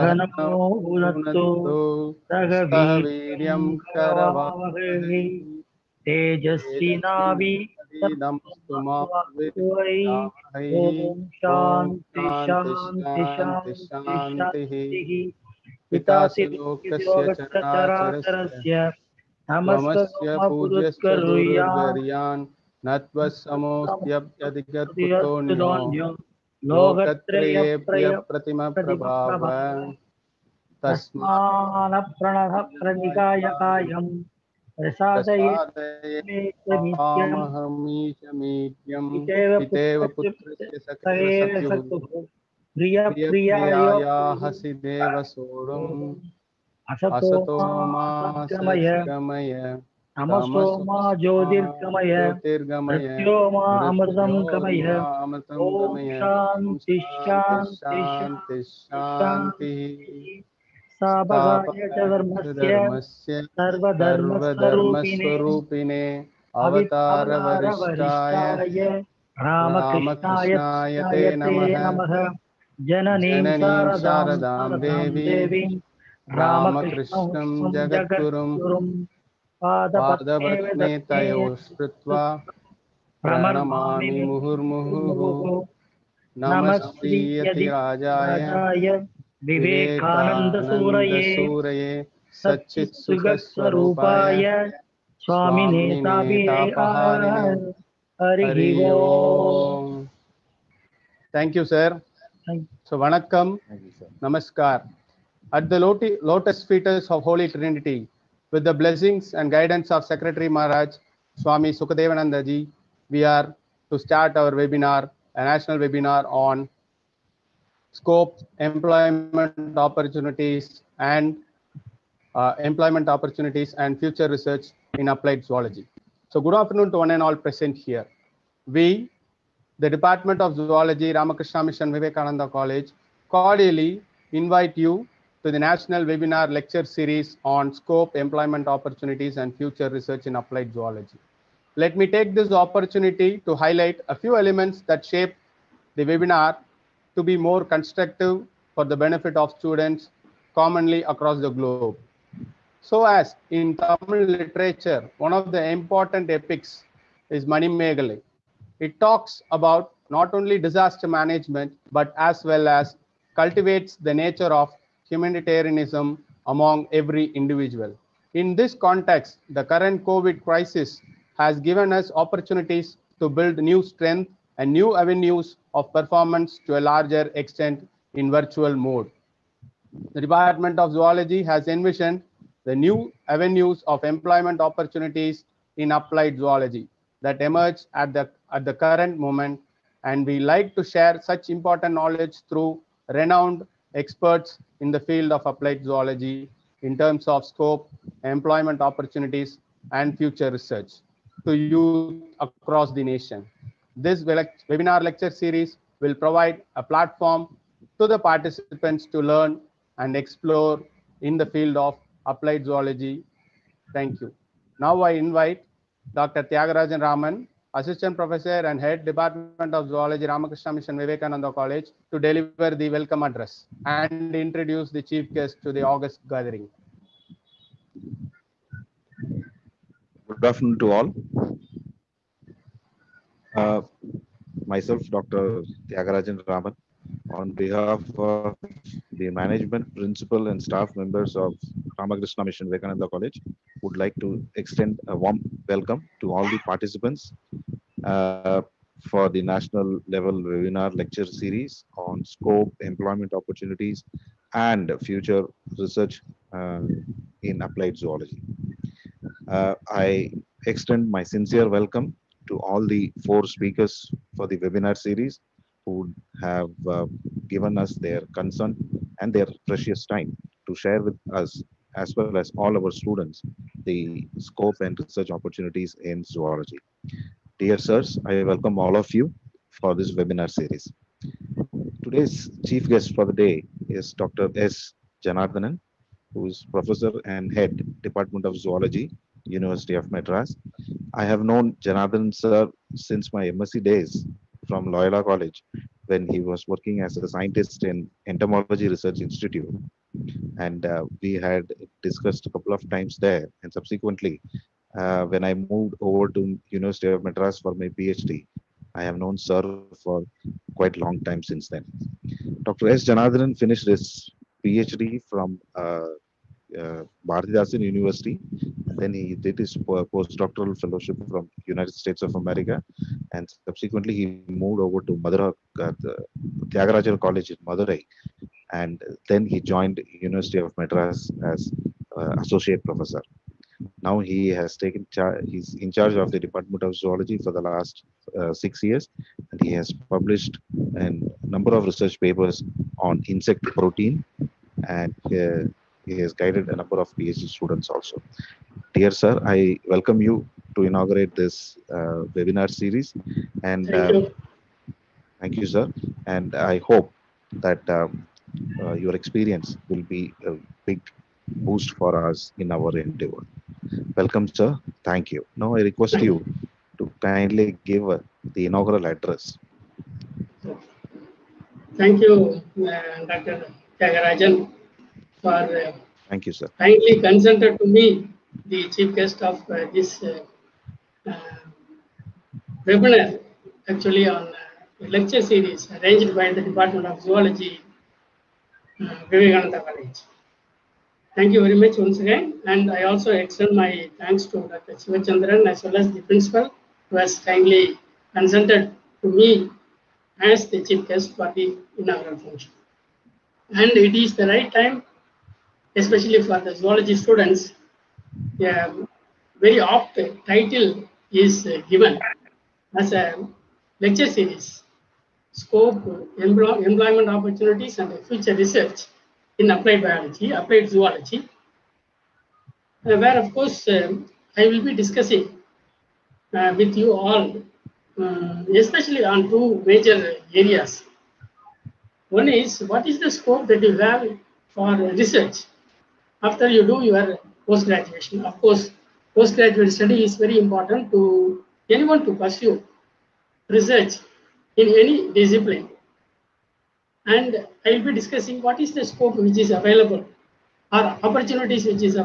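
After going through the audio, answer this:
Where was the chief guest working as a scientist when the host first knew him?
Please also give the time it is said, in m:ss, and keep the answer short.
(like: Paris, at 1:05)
Entomology Research Institute, at 4:58.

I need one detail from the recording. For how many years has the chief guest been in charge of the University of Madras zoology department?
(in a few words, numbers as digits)
6.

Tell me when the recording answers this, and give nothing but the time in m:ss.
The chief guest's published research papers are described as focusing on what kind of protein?
5:43.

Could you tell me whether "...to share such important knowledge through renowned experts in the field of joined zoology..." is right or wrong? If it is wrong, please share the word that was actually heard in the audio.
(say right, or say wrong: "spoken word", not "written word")
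wrong: "applied", not "joined".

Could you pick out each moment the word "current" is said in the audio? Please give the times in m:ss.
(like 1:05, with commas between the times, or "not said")
2:49, 3:08.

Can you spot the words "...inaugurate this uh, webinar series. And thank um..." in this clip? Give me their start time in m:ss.
5:50.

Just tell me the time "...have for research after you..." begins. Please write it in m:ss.
7:13.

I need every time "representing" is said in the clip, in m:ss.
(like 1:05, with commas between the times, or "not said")
not said.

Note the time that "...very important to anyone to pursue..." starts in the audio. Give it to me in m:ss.
7:20.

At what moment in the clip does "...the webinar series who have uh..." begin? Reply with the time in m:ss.
4:24.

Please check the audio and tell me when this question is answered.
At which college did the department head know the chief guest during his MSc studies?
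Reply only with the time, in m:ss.
4:54.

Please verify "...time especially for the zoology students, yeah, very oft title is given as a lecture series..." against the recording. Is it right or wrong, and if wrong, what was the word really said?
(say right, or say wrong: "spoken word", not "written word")
right.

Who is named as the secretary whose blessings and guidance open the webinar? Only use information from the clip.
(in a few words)
Swami Sukadevanandaji.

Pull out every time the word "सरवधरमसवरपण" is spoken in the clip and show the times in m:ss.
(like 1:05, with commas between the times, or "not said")
1:03.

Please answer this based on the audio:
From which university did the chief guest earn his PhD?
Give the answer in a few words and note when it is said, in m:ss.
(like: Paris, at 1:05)
Bharatidasan University, at 5:17.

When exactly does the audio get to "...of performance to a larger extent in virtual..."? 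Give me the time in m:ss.
2:55.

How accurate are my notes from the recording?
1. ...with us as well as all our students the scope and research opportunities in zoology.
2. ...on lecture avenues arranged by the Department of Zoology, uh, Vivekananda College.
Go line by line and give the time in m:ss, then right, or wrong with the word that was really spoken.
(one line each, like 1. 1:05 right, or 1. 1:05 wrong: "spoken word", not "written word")
1. 4:31 right
2. 6:24 wrong: "series", not "avenues".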